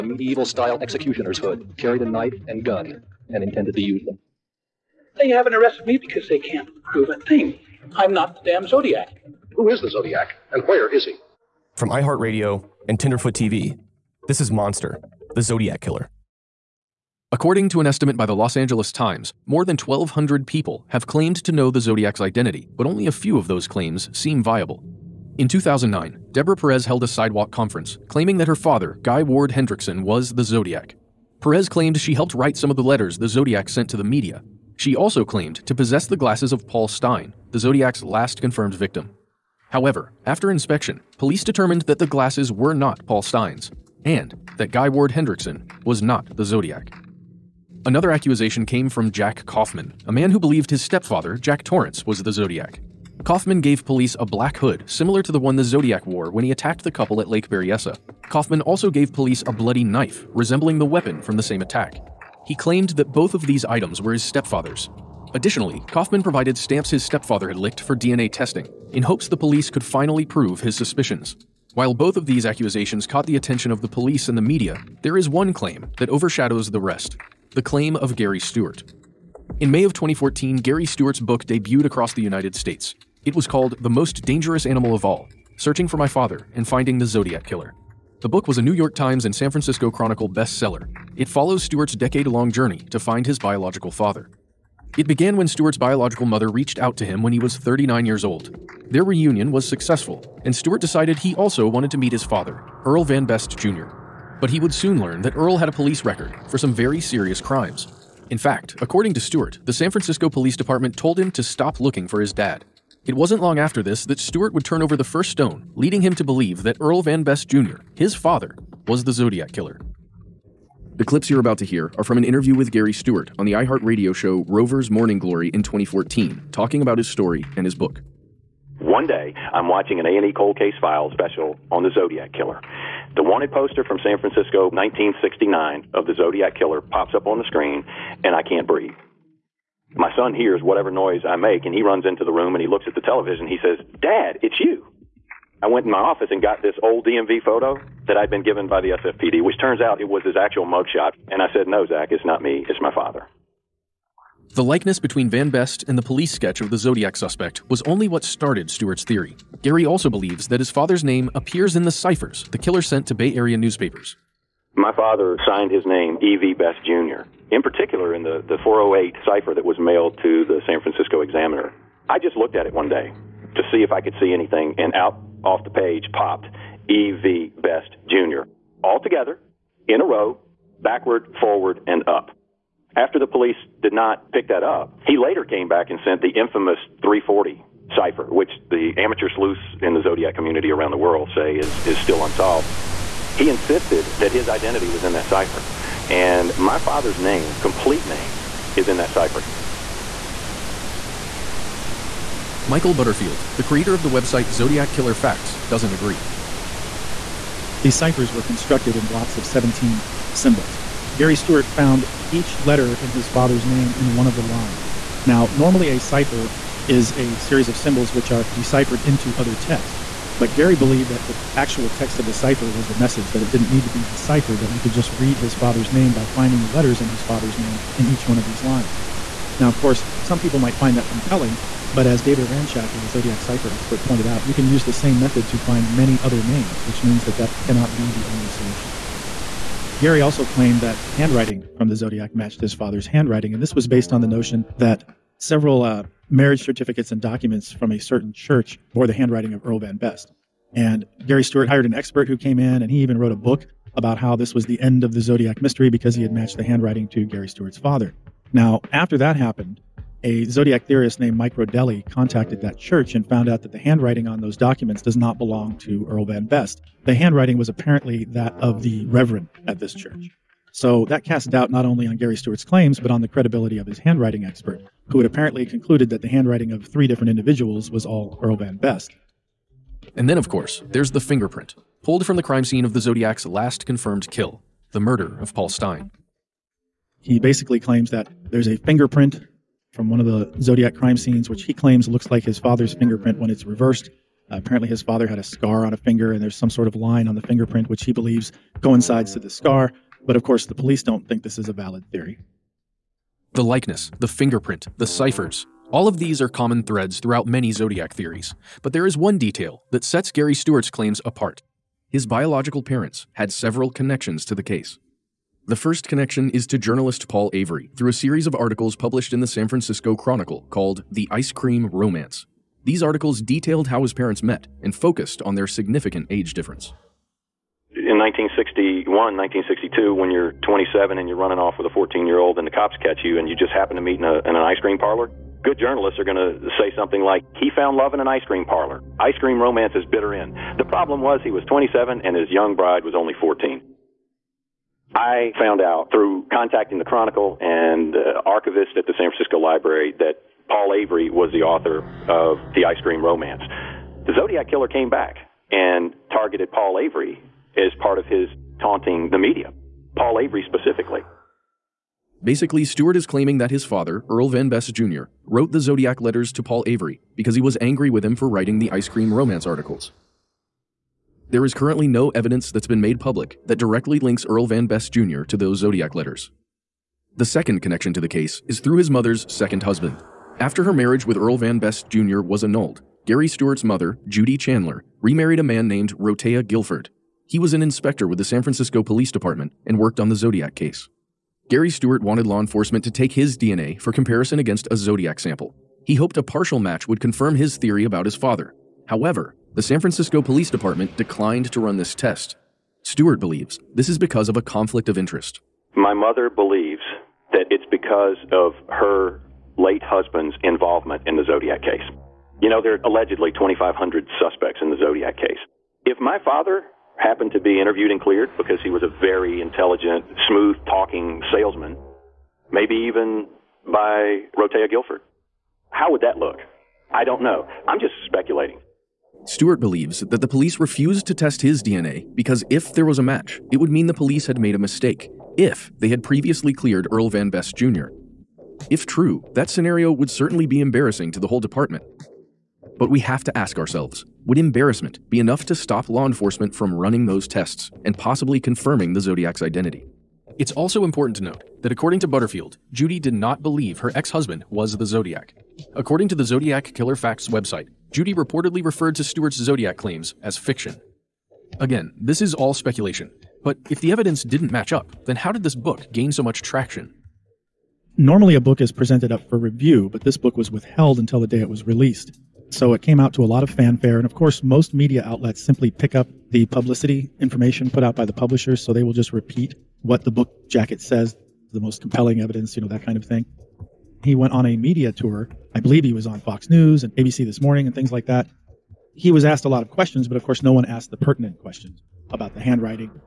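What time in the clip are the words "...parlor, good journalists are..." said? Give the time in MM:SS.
05:34.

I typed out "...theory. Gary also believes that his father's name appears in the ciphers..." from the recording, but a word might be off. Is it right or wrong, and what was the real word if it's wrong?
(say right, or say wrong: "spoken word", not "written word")
right.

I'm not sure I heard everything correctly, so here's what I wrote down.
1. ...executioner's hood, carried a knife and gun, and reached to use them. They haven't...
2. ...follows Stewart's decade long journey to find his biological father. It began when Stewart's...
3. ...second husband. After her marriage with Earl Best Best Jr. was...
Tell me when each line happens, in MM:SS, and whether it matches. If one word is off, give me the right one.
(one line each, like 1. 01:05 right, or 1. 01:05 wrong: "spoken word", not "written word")
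1. 00:00 wrong: "intended", not "reached"
2. 01:31 right
3. 06:19 wrong: "Van", not "Best".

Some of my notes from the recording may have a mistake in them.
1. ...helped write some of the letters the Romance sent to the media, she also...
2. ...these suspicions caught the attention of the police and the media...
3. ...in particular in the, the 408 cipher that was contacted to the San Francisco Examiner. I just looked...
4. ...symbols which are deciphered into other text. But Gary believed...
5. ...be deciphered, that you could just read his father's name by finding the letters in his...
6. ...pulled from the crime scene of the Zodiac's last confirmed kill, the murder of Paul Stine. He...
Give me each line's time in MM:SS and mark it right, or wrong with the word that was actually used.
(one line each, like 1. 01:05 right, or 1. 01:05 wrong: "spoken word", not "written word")
1. 00:32 wrong: "Zodiac", not "Romance"
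2. 01:12 wrong: "accusations", not "suspicions"
3. 02:47 wrong: "mailed", not "contacted"
4. 03:37 right
5. 03:43 right
6. 04:42 right.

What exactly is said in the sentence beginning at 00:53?
Kaufman gave police a black hood similar to the one the Zodiac wore when he attacked the couple at Lake Berryessa.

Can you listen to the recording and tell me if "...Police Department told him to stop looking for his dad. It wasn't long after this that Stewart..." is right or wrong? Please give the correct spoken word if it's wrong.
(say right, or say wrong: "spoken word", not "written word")
right.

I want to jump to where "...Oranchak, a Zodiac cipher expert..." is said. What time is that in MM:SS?
03:52.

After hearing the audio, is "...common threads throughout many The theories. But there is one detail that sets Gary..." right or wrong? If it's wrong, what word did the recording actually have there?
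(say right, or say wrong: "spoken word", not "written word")
wrong: "Zodiac", not "The".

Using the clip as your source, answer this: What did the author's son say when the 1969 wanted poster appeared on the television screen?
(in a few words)
Dad, it's you.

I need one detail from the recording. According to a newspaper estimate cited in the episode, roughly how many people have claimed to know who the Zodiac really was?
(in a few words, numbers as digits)
1,200.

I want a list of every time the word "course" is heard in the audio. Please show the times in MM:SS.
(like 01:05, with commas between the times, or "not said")
03:49, 04:40, 05:00, 07:54, 08:10.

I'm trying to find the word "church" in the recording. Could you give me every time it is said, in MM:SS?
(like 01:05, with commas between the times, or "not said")
04:08, 04:22, 04:29.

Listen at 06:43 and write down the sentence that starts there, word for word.
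Stewart believes this is because of a conflict of interest.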